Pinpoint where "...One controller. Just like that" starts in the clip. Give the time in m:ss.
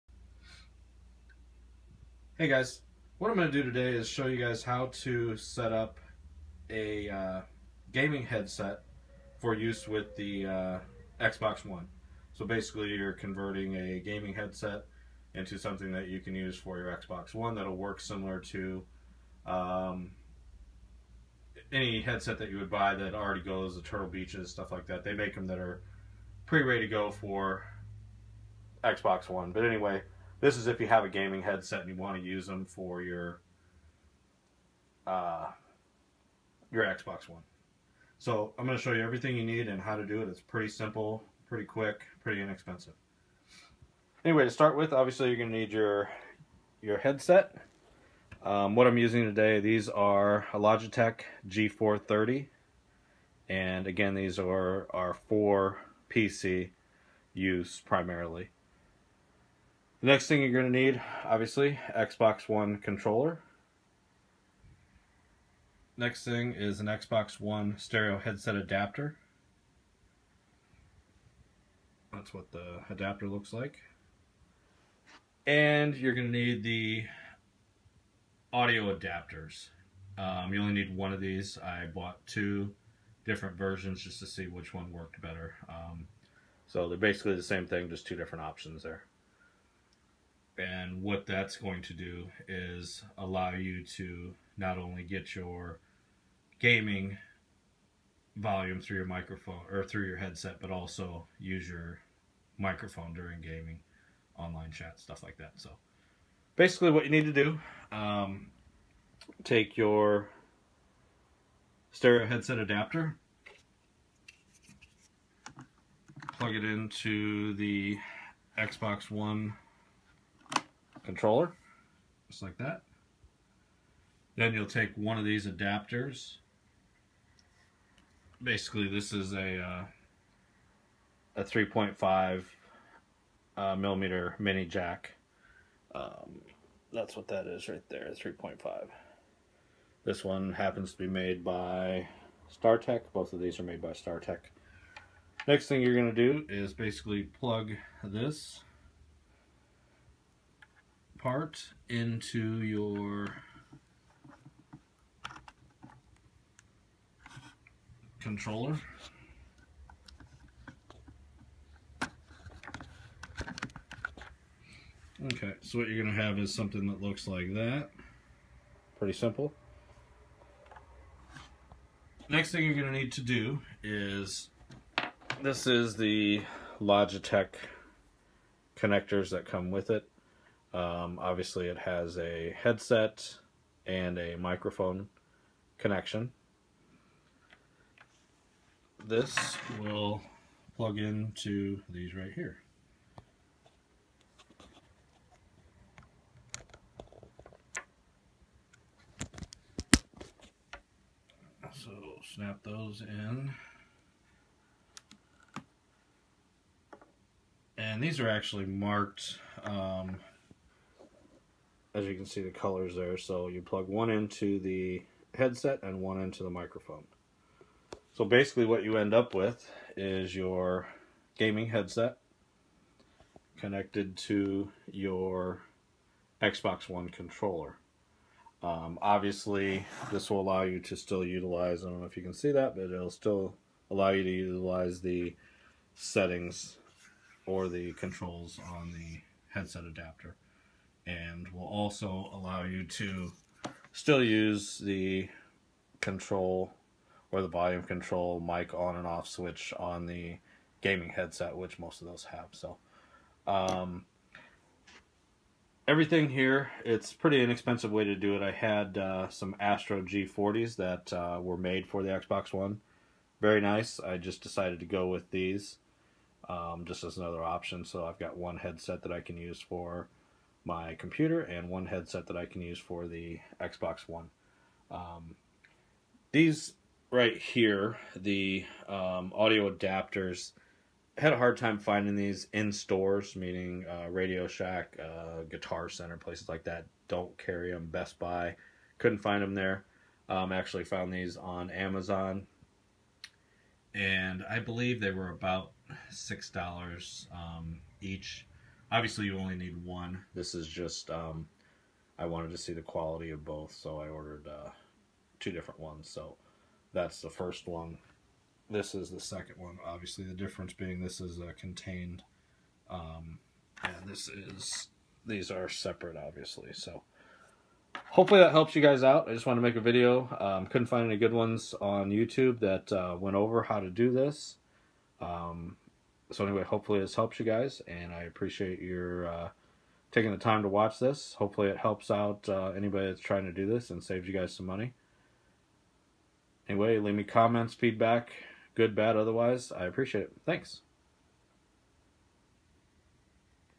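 1:59.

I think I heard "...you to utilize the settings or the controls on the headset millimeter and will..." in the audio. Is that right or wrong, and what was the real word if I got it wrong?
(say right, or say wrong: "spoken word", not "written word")
wrong: "adapter", not "millimeter".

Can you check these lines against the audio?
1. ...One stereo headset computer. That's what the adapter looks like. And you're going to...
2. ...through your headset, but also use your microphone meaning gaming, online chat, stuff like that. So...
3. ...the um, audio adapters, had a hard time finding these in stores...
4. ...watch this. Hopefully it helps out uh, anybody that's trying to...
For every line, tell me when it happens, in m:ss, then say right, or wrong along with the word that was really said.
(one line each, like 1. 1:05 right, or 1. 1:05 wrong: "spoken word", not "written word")
1. 1:07 wrong: "adapter", not "computer"
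2. 1:39 wrong: "during", not "meaning"
3. 4:38 right
4. 5:30 right.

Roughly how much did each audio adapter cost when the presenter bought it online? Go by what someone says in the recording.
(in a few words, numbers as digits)
$6.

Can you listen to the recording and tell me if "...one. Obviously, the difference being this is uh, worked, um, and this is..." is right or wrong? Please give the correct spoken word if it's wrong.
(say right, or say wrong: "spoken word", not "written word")
wrong: "contained", not "worked".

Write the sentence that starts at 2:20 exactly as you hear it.
This one happens to be made by StarTech.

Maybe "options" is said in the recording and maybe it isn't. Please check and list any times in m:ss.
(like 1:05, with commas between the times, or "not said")
1:28, 4:27.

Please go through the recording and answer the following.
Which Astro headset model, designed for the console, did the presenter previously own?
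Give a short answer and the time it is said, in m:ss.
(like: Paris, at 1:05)
Astro G40, at 4:19.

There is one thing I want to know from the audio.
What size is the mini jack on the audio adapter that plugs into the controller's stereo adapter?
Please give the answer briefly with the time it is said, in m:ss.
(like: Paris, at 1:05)
3.5 millimeter, at 2:11.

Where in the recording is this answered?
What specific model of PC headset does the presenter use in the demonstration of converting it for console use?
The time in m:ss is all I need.
0:50.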